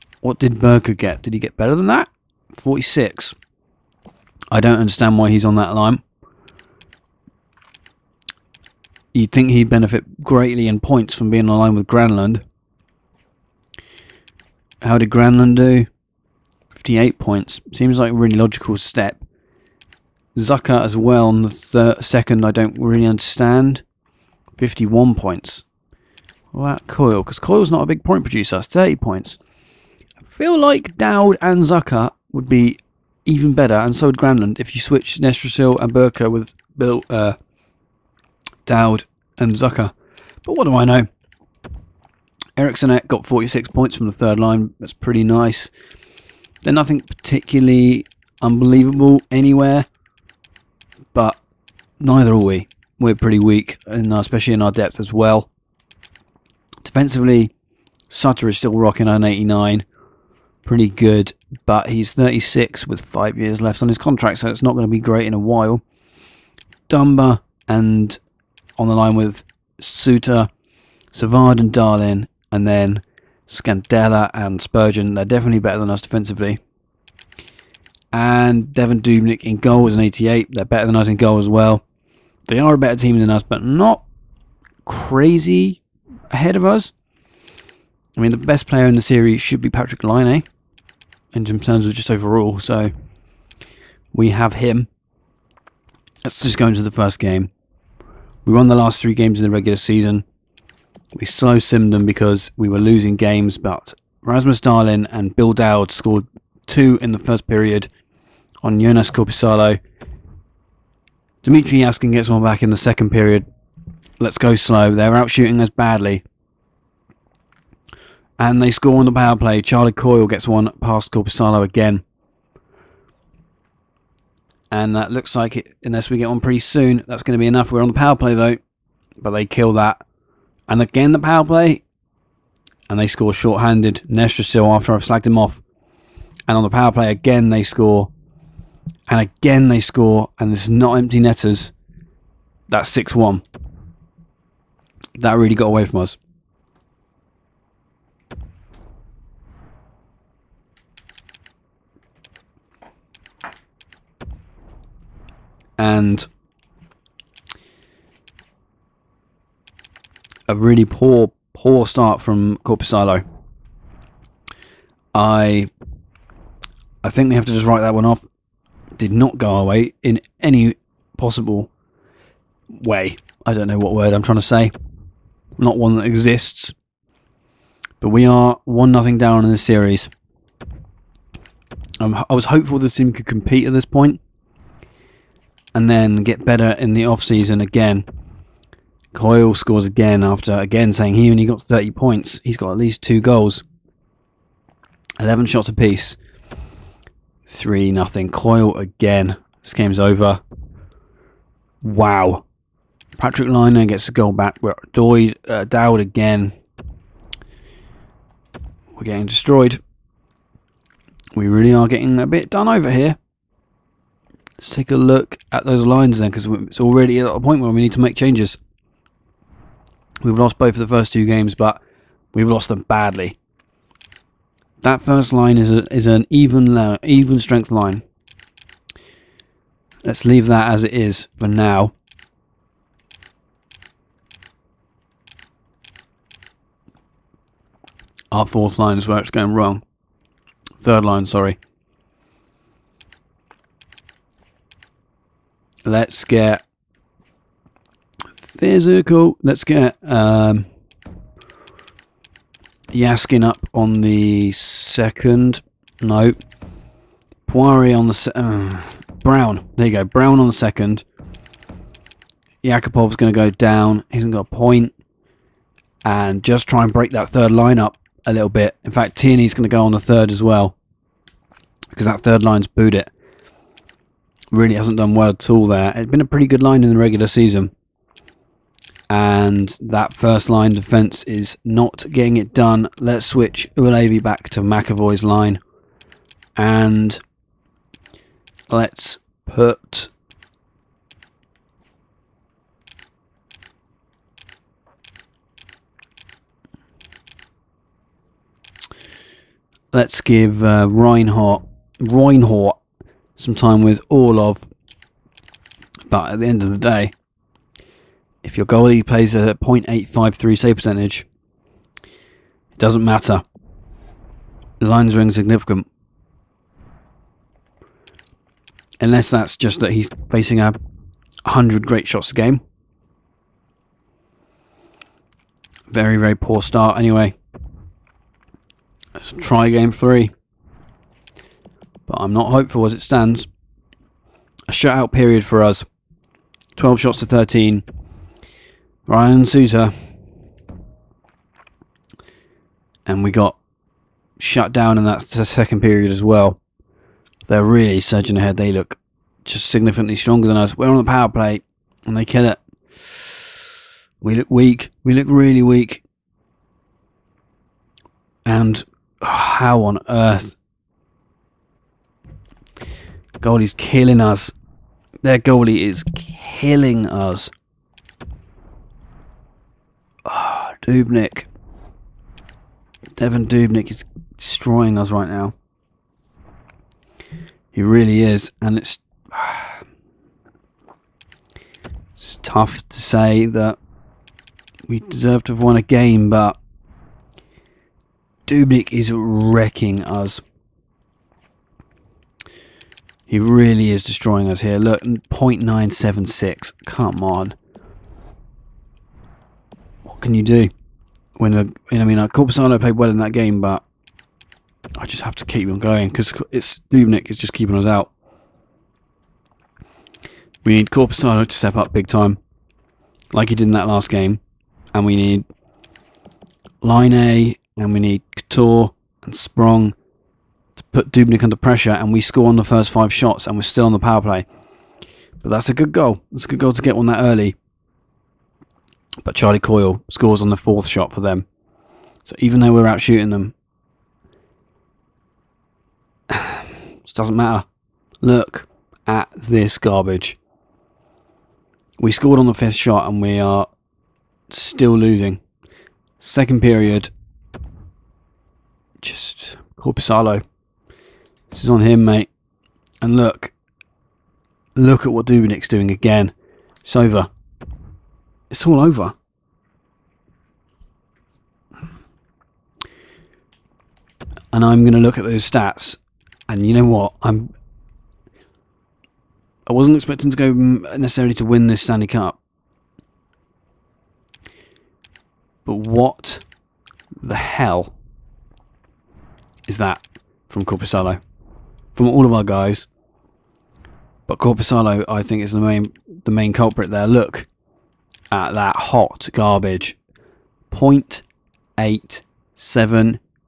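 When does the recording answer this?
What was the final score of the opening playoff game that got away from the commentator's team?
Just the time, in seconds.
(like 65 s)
142 s.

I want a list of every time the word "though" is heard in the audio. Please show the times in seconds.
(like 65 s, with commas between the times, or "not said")
128 s, 432 s.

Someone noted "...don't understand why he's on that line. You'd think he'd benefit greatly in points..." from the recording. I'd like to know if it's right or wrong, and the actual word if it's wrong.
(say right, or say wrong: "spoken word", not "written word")
right.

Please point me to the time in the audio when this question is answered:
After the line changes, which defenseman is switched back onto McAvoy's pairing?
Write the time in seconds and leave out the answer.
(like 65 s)
283 s.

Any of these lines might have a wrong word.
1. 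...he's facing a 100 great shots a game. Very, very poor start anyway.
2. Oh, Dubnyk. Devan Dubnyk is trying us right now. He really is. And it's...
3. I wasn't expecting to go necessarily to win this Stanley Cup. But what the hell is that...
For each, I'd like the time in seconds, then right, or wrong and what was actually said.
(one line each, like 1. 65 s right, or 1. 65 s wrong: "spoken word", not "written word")
1. 319 s right
2. 370 s wrong: "destroying", not "trying"
3. 469 s right.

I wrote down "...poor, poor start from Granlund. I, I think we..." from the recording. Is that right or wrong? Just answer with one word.
wrong.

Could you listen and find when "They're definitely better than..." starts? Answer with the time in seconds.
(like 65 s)
75 s.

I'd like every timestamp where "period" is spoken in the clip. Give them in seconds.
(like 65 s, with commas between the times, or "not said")
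107 s, 113 s, 335 s, 345 s, 446 s.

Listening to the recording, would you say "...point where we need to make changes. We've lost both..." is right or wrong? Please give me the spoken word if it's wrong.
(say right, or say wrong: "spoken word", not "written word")
right.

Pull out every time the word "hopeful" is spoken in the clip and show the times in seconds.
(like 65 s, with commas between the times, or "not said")
182 s, 332 s.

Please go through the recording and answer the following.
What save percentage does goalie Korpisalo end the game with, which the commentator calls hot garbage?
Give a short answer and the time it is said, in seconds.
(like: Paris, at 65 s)
0.878, at 490 s.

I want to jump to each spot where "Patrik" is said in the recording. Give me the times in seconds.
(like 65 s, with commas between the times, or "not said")
89 s, 203 s.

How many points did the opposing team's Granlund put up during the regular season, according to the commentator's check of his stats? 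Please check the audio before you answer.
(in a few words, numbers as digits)
58.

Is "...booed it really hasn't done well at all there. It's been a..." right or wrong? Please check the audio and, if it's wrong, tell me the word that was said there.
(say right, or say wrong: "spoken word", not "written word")
right.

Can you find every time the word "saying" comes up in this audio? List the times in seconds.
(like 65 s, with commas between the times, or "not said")
190 s.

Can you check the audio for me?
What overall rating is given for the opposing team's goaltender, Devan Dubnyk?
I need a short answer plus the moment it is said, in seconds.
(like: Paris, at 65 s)
88, at 79 s.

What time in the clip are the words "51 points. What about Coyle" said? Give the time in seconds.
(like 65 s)
24 s.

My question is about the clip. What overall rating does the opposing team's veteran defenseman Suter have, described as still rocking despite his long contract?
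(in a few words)
89.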